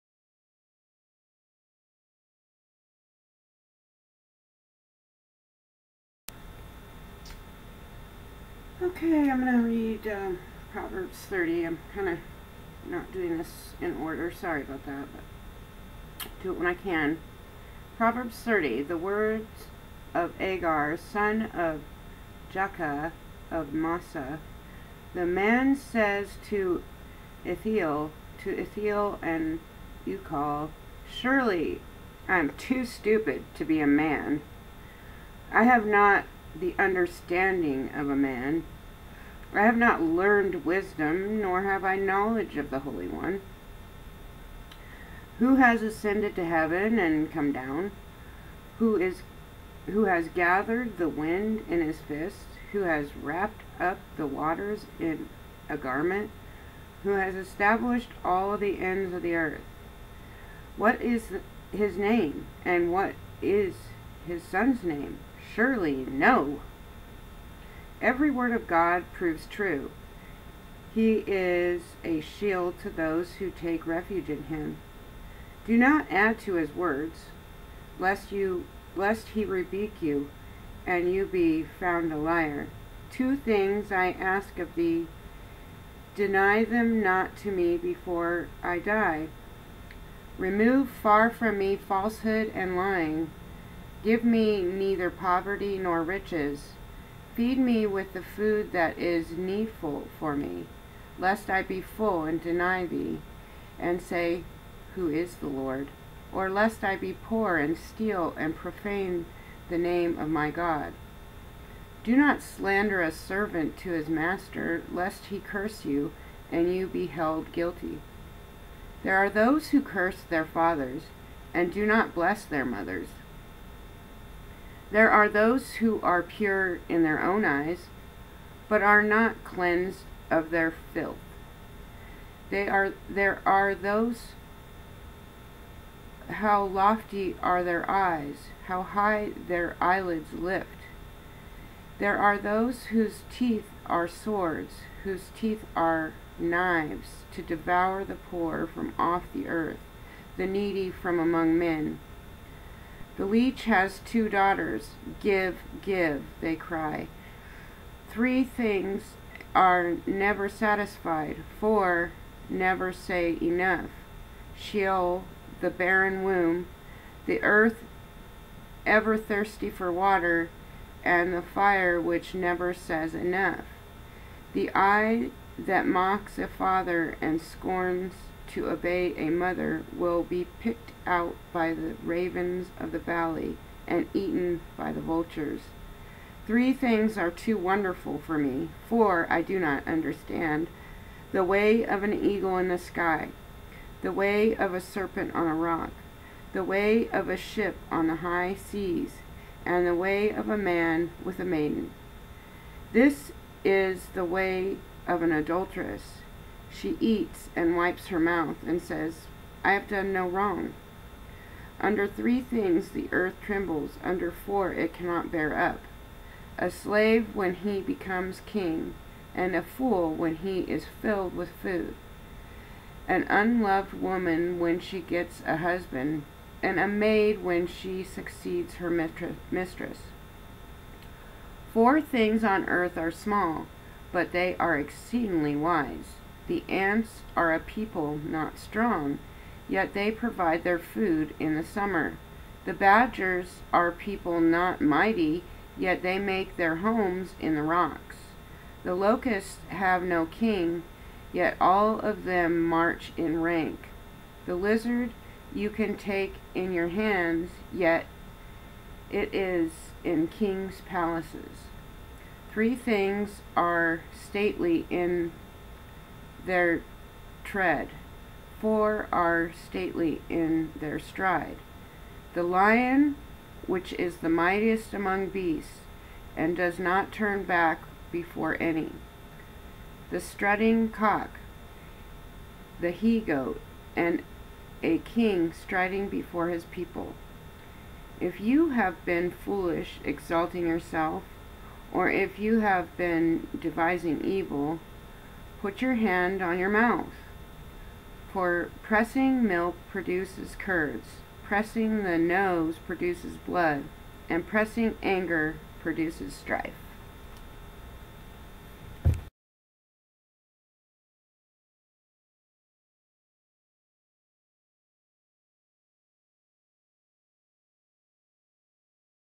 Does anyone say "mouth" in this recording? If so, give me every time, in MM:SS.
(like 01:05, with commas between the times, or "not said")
03:28, 04:56.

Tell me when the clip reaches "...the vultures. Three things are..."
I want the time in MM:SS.
03:04.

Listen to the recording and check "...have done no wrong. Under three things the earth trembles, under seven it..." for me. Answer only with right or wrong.
wrong.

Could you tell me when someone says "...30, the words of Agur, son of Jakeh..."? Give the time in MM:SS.
00:18.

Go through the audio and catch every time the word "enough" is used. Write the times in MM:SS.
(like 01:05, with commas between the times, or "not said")
02:43, 02:53.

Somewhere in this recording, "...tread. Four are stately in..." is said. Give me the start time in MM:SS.
04:27.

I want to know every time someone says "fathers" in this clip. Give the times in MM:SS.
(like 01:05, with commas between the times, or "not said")
02:00, 02:56.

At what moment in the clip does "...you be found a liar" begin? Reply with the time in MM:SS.
01:21.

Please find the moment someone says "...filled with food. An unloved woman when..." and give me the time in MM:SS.
03:41.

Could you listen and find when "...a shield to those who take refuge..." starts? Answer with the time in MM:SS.
01:12.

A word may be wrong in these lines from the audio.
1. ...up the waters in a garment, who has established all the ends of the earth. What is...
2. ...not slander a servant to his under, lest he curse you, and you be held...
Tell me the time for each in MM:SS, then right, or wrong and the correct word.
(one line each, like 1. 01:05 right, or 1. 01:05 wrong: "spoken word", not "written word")
1. 00:53 right
2. 01:52 wrong: "master", not "under".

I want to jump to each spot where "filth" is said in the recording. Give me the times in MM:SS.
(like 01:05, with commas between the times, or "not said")
02:10.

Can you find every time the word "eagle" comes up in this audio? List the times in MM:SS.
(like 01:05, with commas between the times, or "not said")
03:12.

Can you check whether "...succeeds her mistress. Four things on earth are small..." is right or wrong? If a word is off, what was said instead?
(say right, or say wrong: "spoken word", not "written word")
right.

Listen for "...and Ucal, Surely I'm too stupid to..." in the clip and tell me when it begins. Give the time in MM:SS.
00:29.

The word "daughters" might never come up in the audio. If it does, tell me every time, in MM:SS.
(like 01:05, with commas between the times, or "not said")
02:34.